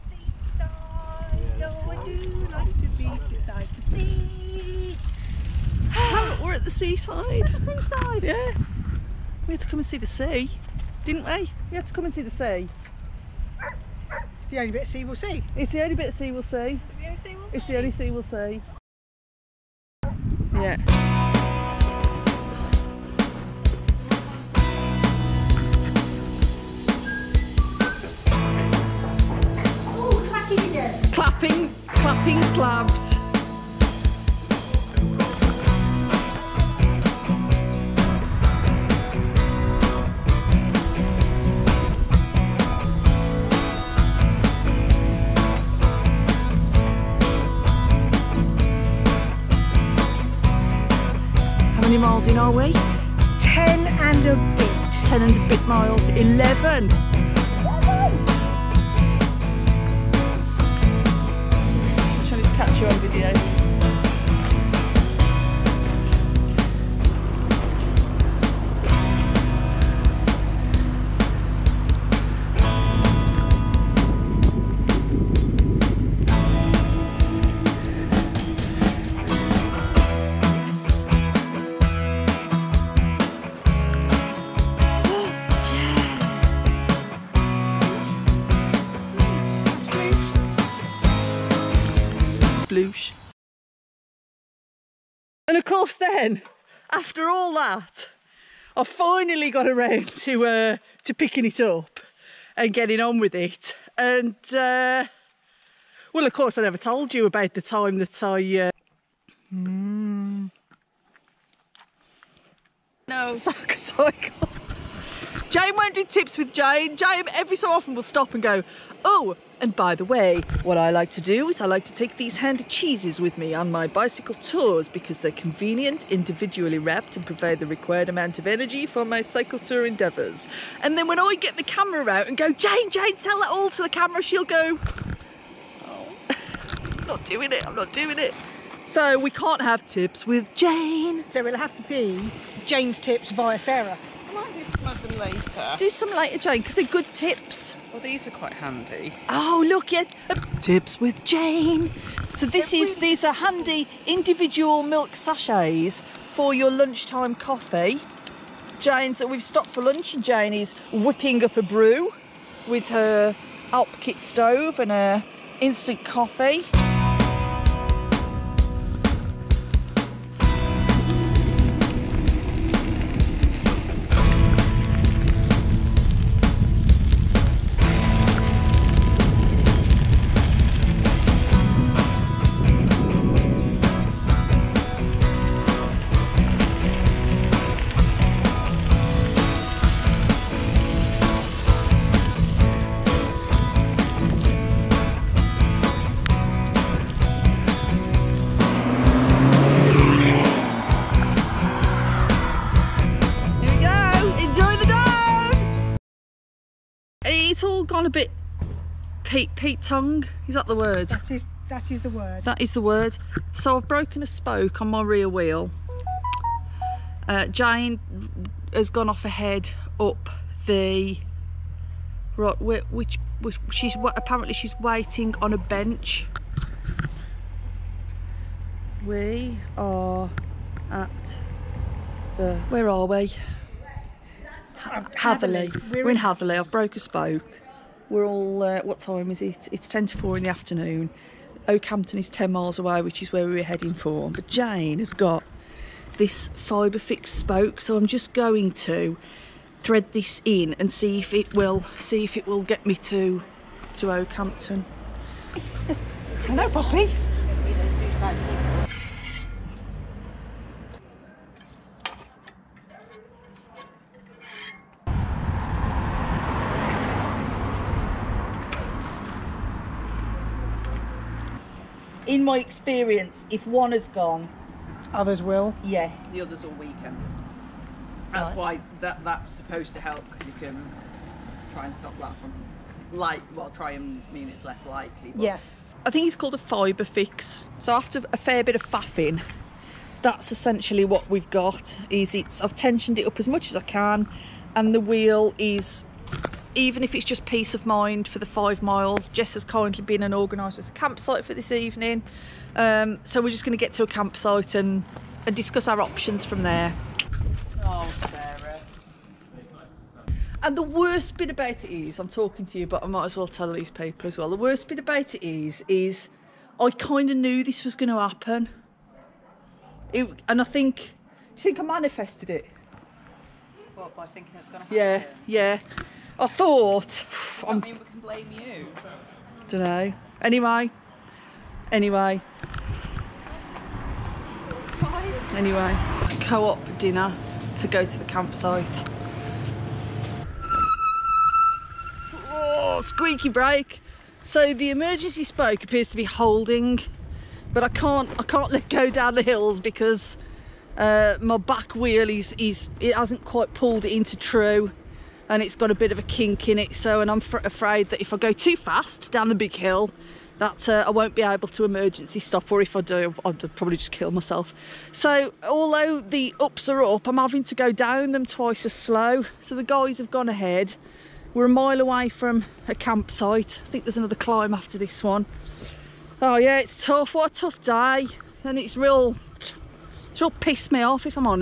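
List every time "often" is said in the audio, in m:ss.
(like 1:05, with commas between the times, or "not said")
1:57.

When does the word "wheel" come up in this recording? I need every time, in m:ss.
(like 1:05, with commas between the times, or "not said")
3:35, 4:55, 5:51.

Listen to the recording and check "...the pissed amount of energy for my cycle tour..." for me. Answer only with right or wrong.
wrong.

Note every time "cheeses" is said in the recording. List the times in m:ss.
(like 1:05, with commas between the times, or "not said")
2:02.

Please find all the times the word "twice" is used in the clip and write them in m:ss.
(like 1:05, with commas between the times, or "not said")
6:08.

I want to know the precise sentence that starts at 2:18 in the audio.
So we can't have tips with Jane.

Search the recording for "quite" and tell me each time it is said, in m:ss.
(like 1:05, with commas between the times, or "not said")
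2:28, 5:53.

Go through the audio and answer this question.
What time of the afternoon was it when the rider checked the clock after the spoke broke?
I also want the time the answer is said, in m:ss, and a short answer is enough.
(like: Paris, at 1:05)
ten to four, at 3:59.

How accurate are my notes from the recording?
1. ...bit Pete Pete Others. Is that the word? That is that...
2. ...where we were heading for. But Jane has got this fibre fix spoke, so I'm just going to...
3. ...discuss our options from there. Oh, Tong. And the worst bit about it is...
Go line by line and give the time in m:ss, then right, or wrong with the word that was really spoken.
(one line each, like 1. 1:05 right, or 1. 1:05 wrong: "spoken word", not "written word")
1. 3:28 wrong: "Tong", not "Others"
2. 4:03 right
3. 5:05 wrong: "Sarah", not "Tong".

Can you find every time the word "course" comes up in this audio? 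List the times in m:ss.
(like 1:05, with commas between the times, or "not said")
1:35, 1:46.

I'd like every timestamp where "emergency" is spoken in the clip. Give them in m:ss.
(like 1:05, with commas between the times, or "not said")
5:44, 6:01.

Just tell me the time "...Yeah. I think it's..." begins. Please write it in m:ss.
4:45.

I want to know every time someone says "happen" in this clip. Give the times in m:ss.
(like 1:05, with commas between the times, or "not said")
5:18, 5:24.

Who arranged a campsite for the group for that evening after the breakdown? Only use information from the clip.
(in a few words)
Jess.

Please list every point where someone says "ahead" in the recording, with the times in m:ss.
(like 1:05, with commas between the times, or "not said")
3:39, 6:10.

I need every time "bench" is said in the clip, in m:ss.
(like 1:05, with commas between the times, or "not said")
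3:45.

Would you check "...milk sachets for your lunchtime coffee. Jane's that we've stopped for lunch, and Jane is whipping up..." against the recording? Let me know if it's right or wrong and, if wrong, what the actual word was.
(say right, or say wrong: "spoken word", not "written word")
right.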